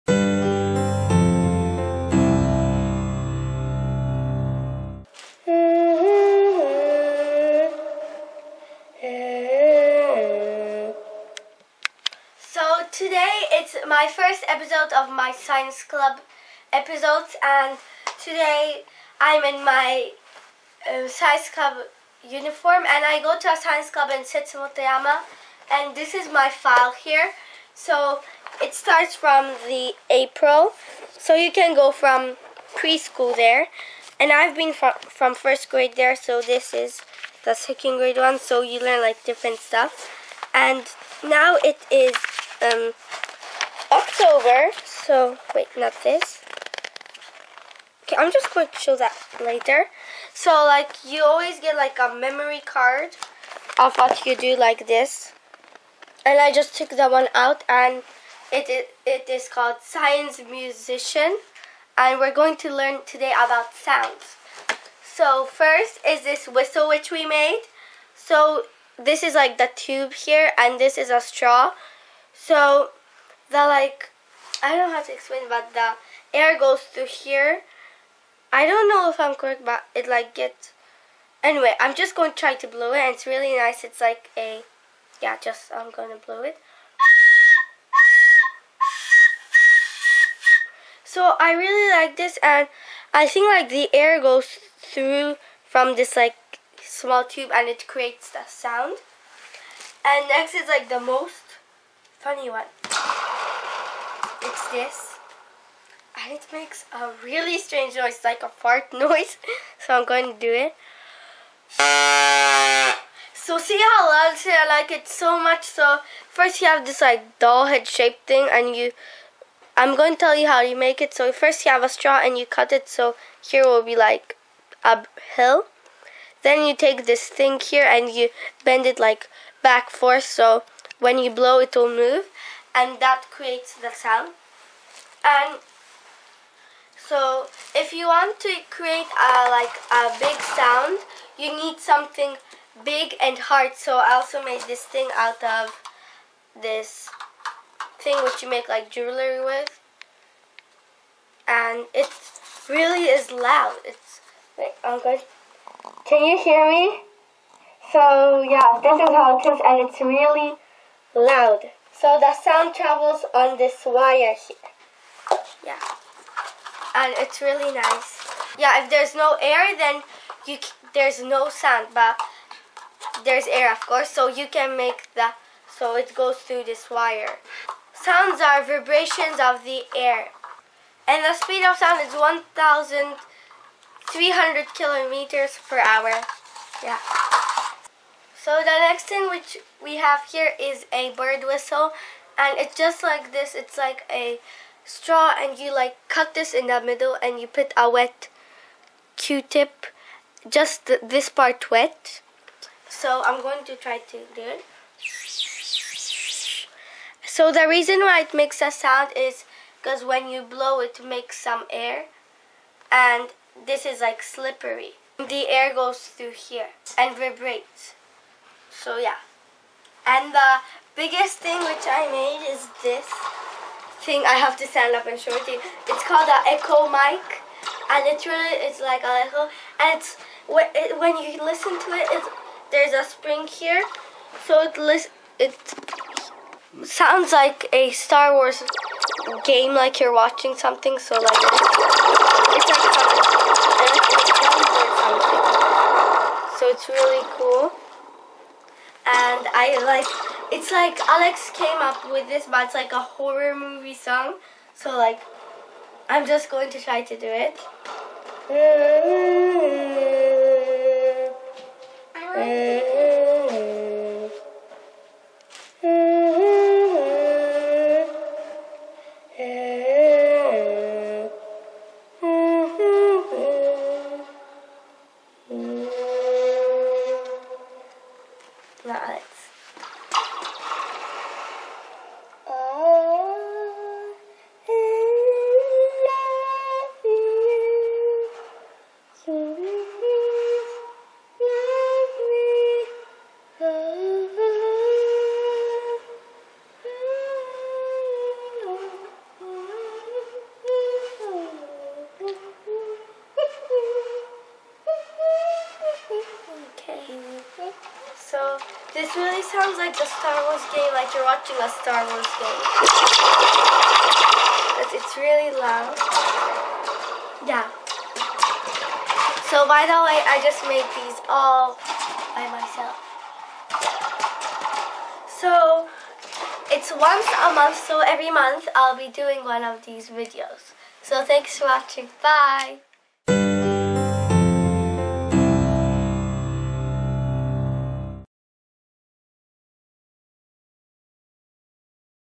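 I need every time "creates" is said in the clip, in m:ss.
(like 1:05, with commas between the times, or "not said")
1:37, 2:13, 2:18.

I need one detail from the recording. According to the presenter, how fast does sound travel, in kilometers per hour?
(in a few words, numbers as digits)
1,300 km/h.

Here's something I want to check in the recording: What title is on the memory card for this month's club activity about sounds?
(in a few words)
Science Musician.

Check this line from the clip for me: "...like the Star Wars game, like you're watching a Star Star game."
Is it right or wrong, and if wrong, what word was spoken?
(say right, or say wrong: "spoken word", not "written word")
wrong: "Wars", not "Star".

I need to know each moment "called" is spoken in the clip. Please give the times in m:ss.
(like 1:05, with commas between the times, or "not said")
0:59, 3:46.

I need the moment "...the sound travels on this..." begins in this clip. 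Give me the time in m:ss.
2:42.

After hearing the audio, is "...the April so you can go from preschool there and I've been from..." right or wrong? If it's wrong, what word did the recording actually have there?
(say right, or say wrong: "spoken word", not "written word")
right.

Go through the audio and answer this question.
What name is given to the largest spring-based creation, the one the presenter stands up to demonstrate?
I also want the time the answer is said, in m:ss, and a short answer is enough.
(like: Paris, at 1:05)
Echo mic, at 3:46.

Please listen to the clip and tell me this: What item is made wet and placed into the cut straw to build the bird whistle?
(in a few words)
Q-tip.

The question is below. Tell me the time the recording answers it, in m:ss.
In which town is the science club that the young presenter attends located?
0:24.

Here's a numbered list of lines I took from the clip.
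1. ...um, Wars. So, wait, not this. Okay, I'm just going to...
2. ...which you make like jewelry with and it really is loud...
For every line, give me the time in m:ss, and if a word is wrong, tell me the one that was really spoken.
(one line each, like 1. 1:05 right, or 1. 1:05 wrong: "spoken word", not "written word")
1. 0:42 wrong: "October", not "Wars"
2. 2:28 right.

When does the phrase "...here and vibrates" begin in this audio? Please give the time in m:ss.
3:36.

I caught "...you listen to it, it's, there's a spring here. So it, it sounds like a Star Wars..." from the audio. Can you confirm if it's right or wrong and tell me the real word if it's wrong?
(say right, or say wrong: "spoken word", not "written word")
right.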